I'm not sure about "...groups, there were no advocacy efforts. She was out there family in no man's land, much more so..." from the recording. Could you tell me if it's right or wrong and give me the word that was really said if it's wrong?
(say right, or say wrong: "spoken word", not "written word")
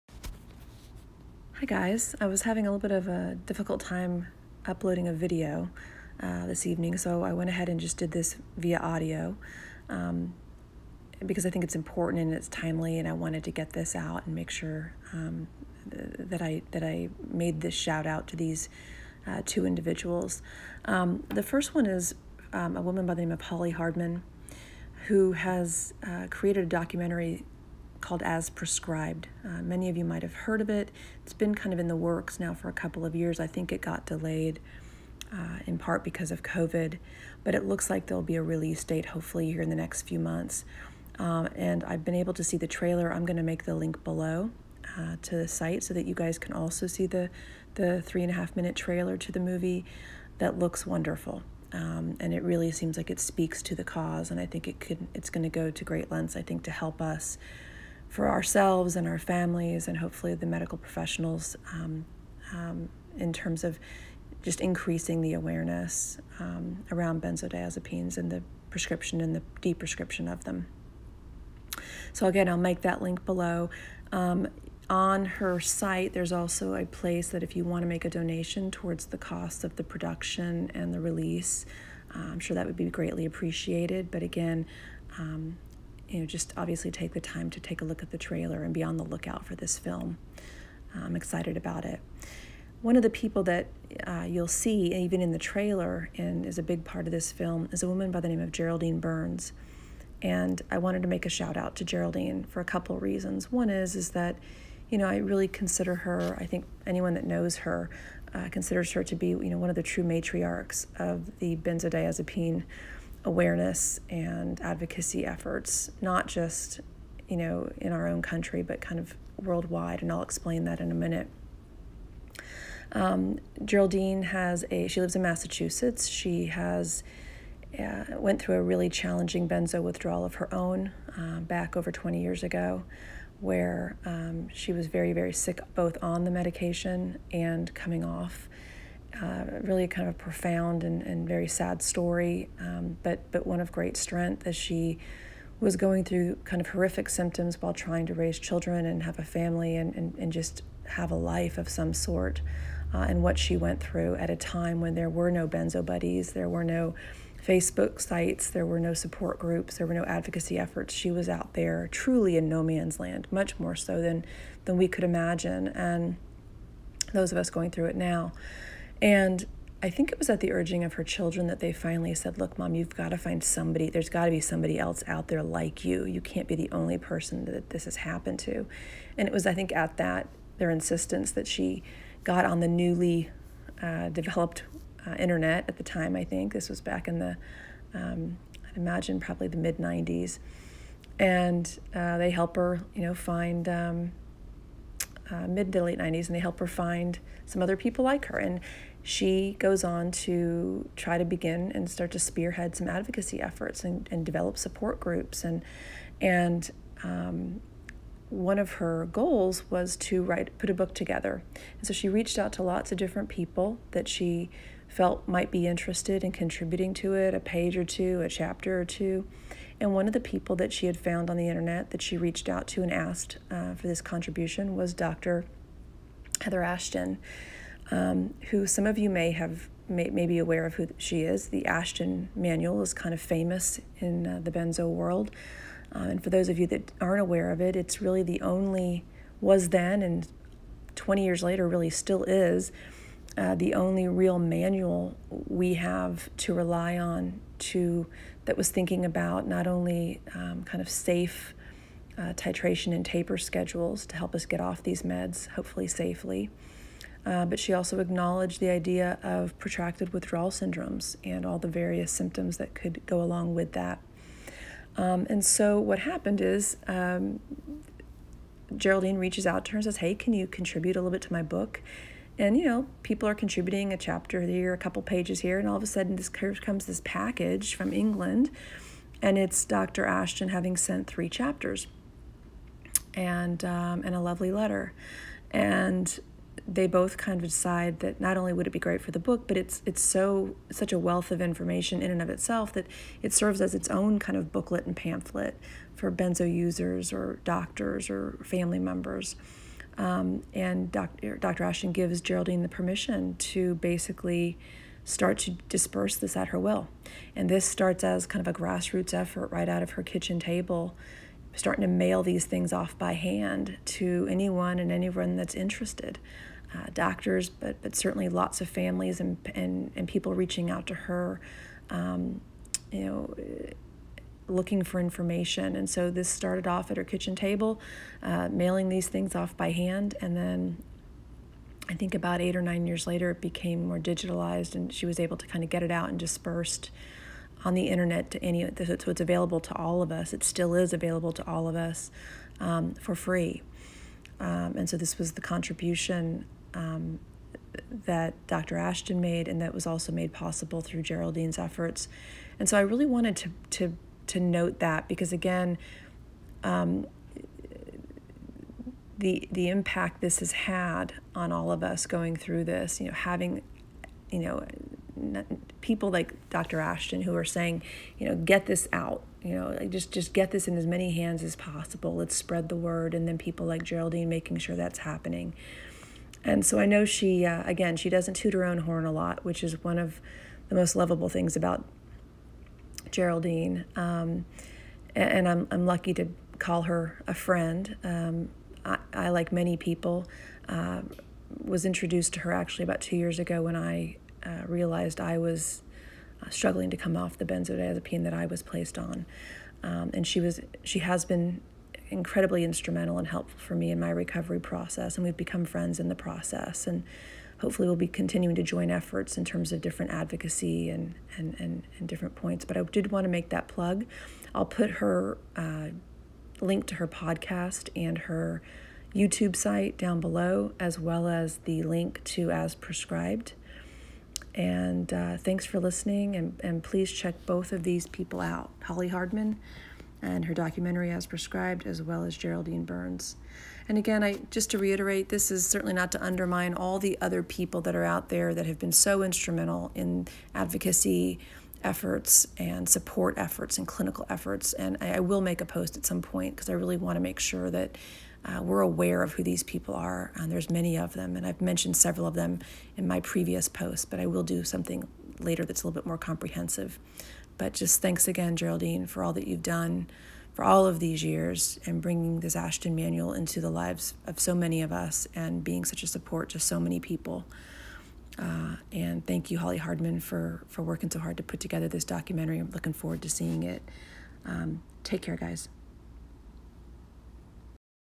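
wrong: "truly", not "family".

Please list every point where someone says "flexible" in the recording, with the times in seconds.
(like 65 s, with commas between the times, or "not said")
not said.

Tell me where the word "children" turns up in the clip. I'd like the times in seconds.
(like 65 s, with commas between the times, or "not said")
148 s, 171 s.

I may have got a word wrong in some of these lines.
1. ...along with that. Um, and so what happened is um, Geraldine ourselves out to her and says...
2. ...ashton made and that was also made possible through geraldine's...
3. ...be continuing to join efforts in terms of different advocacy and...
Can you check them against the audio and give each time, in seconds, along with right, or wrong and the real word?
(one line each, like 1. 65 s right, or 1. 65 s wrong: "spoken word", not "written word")
1. 263 s wrong: "reaches", not "ourselves"
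2. 348 s right
3. 407 s right.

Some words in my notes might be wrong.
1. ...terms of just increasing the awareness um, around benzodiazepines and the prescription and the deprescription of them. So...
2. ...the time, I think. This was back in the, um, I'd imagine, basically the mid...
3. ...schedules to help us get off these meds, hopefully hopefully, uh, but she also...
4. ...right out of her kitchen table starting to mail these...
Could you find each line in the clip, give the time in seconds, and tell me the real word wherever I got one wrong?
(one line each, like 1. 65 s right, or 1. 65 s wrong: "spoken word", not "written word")
1. 63 s right
2. 185 s wrong: "probably", not "basically"
3. 253 s wrong: "safely", not "hopefully"
4. 309 s right.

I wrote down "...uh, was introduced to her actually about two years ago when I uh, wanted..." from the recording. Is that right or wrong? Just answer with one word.
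wrong.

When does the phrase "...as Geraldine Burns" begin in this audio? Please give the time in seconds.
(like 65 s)
432 s.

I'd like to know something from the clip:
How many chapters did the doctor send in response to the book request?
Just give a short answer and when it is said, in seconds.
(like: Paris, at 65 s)
3, at 281 s.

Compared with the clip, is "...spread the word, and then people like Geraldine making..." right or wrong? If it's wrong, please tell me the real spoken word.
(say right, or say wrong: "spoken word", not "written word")
right.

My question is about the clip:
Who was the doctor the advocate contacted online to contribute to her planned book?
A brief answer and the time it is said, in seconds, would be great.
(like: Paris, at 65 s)
Heather Ashton, at 226 s.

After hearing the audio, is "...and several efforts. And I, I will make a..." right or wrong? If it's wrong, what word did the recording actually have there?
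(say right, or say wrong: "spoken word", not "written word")
wrong: "clinical", not "several".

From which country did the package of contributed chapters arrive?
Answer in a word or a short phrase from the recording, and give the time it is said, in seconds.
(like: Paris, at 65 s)
England, at 277 s.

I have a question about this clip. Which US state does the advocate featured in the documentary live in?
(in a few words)
Massachusetts.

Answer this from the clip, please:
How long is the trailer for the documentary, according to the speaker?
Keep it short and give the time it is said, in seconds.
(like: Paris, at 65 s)
3.5 minutes, at 48 s.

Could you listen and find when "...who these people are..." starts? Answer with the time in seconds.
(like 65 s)
449 s.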